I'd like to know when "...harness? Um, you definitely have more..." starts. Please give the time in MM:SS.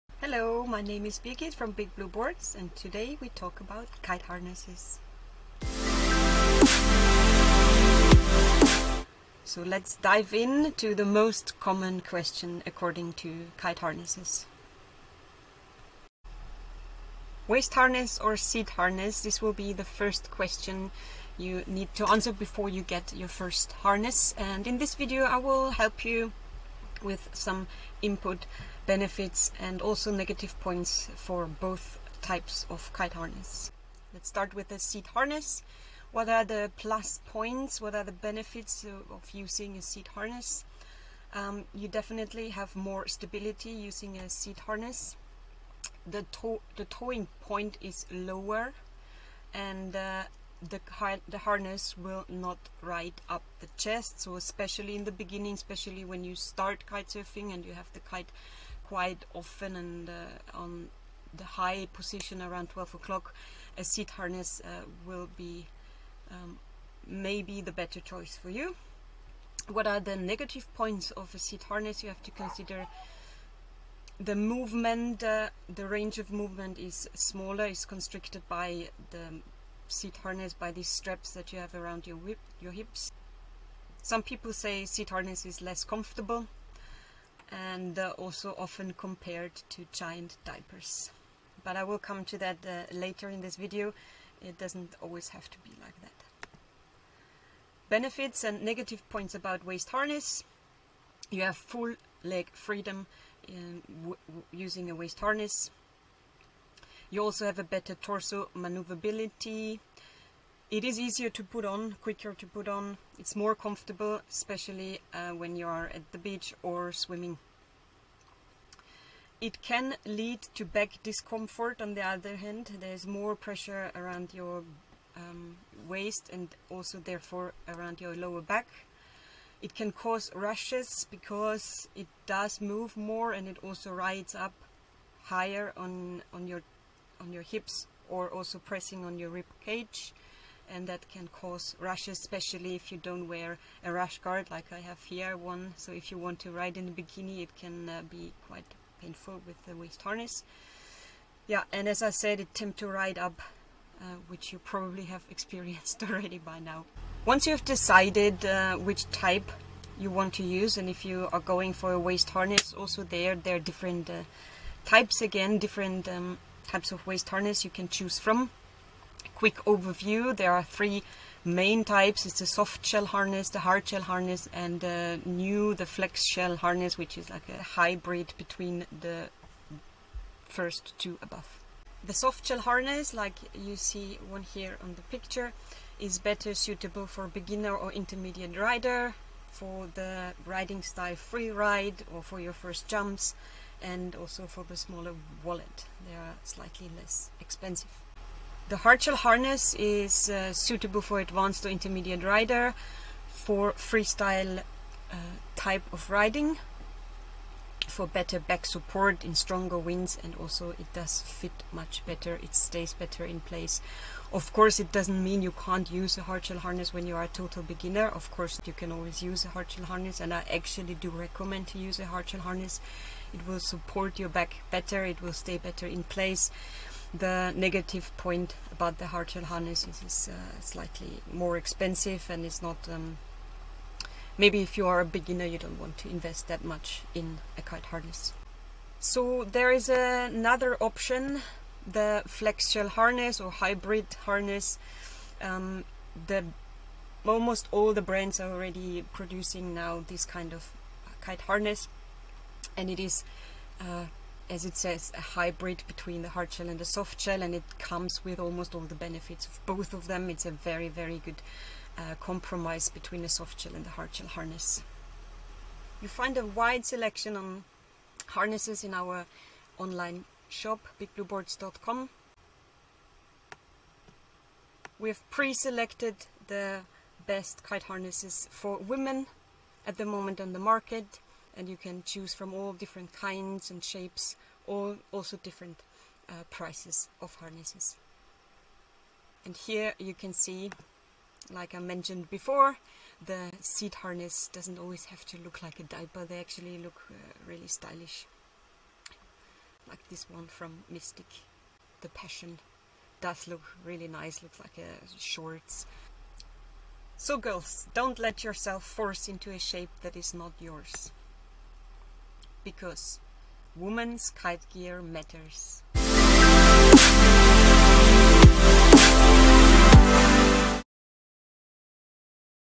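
00:40.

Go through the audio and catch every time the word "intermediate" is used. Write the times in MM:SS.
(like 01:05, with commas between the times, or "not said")
03:07, 03:21.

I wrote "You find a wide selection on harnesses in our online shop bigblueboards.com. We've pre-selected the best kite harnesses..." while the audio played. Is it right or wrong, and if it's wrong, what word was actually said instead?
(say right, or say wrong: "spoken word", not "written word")
right.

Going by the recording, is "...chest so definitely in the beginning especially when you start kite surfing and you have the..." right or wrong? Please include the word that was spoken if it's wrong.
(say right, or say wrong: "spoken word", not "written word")
wrong: "especially", not "definitely".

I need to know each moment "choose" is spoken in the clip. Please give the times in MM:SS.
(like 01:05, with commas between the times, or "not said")
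02:47, 04:42.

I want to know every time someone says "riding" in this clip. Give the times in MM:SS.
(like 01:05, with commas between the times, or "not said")
03:10, 03:26.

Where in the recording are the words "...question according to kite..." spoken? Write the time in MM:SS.
00:11.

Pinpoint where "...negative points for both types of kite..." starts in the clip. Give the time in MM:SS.
00:30.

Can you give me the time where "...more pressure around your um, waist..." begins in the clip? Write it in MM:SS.
02:03.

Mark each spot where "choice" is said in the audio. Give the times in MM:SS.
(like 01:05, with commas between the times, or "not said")
01:07.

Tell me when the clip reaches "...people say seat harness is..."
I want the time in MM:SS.
01:24.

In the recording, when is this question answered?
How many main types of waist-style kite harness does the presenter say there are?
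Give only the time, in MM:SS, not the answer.
02:50.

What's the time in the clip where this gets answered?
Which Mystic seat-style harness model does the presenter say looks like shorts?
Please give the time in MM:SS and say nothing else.
05:02.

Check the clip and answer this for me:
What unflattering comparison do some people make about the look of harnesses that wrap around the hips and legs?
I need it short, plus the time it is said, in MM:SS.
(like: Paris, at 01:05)
Giant diapers, at 01:29.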